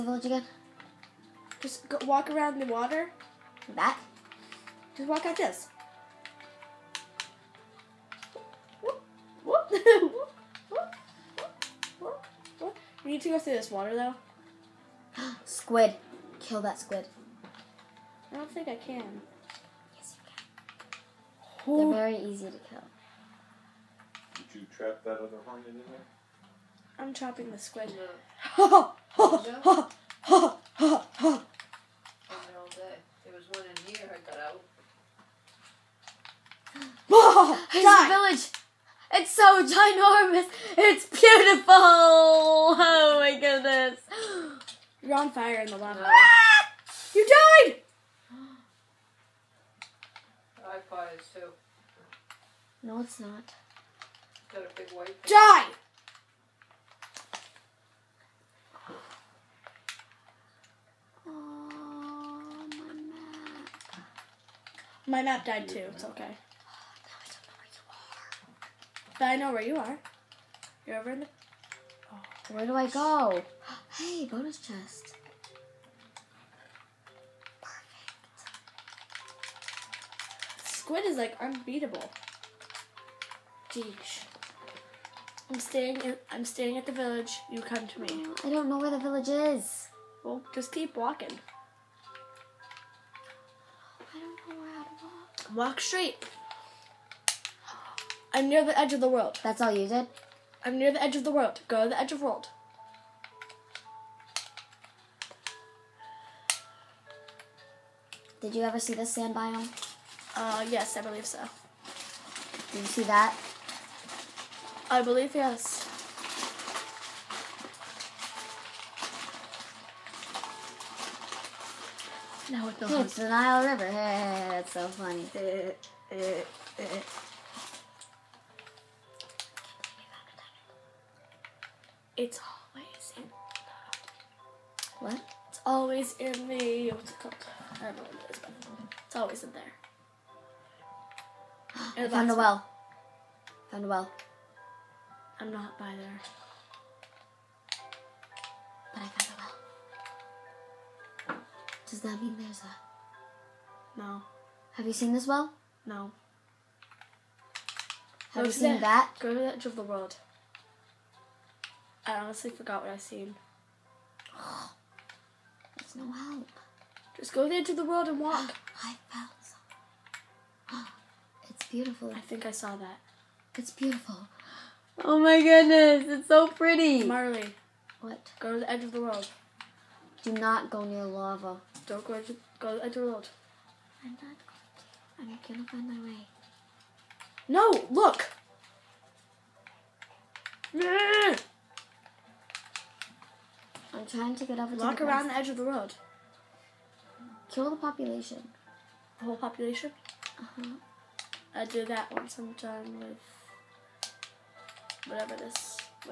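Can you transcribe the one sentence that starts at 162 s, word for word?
I honestly forgot what I seen.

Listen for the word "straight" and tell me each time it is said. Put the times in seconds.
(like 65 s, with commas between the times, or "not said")
95 s.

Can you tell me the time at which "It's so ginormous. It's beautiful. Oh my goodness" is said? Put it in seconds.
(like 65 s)
39 s.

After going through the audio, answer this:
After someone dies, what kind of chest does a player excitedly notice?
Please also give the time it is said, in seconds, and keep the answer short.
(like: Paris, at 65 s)
Bonus chest, at 74 s.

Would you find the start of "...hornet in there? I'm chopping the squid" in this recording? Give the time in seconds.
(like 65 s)
25 s.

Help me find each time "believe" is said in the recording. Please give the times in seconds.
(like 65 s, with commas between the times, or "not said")
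111 s, 115 s.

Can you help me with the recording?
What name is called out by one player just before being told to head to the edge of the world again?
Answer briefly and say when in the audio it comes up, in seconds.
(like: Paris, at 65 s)
Marley, at 177 s.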